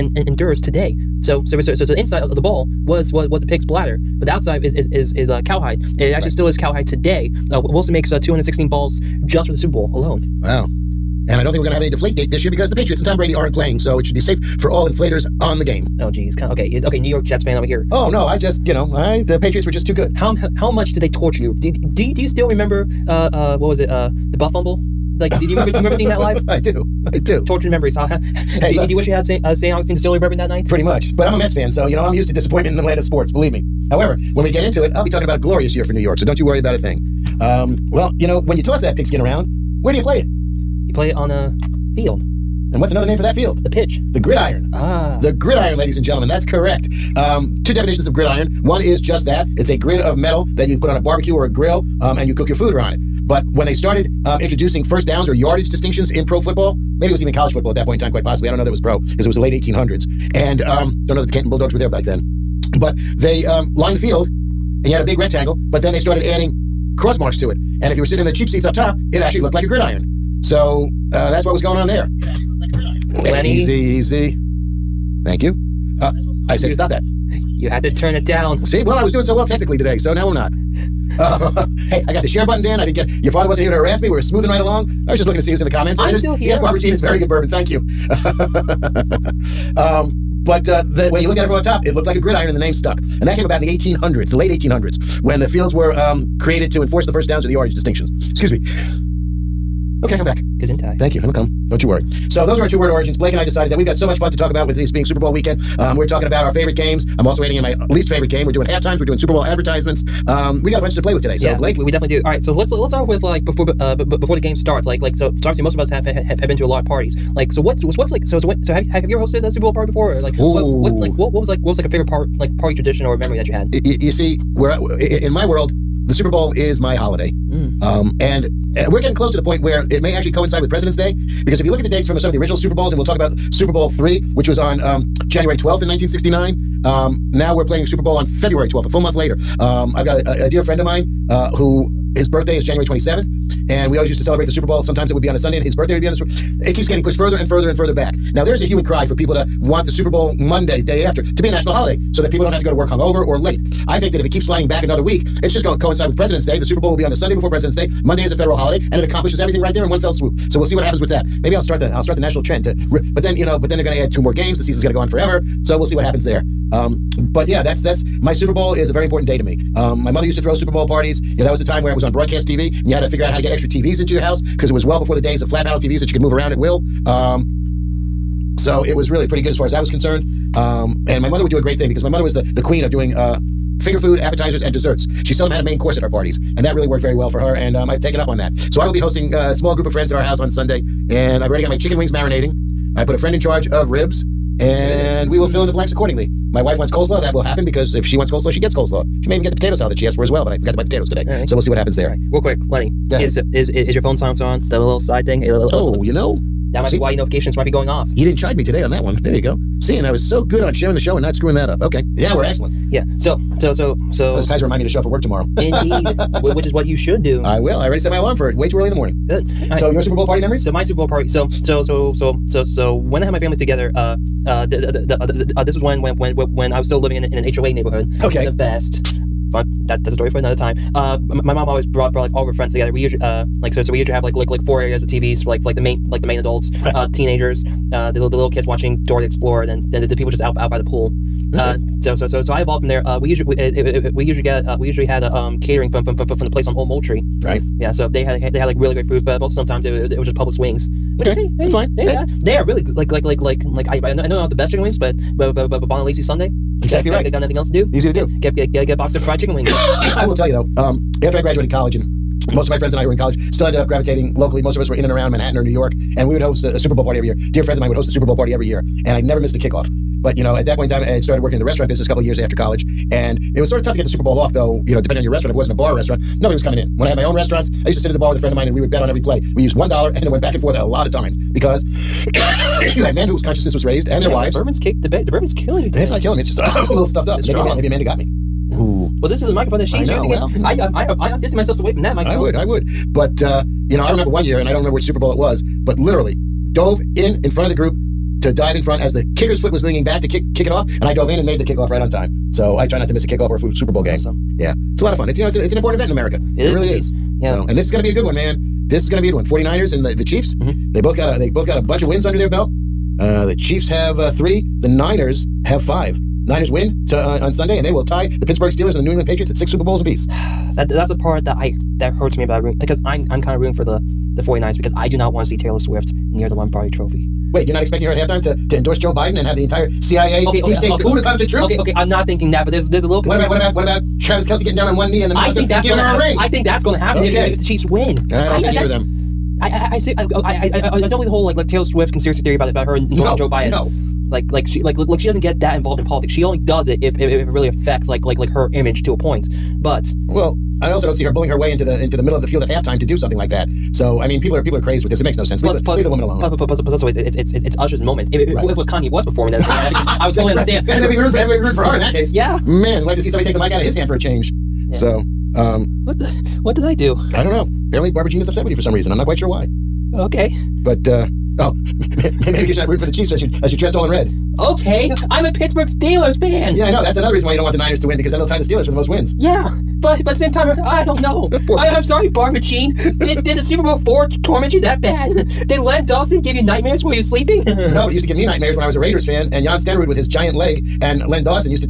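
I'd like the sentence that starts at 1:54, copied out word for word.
Like like so so obviously most of us have have, have been to a lot of parties.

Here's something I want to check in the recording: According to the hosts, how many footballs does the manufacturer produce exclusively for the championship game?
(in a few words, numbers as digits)
216.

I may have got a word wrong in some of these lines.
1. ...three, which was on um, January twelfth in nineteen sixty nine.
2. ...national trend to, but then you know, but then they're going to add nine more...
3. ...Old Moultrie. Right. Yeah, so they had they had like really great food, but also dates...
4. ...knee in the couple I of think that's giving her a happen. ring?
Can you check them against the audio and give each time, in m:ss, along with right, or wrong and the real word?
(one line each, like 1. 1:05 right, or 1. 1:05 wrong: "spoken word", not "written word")
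1. 2:13 right
2. 2:42 wrong: "two", not "nine"
3. 4:06 wrong: "sometimes", not "dates"
4. 5:35 wrong: "middle", not "couple".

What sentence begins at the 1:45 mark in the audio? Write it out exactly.
Um, we're talking about our favorite games.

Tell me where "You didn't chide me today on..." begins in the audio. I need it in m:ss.
3:28.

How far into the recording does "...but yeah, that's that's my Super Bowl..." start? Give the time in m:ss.
2:47.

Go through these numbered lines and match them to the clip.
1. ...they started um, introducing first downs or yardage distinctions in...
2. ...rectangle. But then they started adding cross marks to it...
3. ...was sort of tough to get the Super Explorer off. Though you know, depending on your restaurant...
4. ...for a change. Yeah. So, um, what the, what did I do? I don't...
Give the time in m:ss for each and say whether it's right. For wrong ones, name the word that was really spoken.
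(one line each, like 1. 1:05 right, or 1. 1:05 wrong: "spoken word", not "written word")
1. 0:53 right
2. 1:05 right
3. 4:33 wrong: "Bowl", not "Explorer"
4. 6:04 right.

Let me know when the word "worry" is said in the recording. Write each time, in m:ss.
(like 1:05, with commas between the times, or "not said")
0:36, 1:41.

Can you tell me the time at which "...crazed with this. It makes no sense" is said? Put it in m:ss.
5:54.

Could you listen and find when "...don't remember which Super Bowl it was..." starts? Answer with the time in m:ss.
4:54.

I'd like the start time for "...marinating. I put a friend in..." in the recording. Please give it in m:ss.
3:12.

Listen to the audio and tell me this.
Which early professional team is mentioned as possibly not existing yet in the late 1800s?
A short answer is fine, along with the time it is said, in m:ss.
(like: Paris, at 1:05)
Canton Bulldogs, at 1:01.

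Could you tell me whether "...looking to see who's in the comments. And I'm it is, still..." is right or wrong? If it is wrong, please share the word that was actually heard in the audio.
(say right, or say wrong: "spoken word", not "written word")
right.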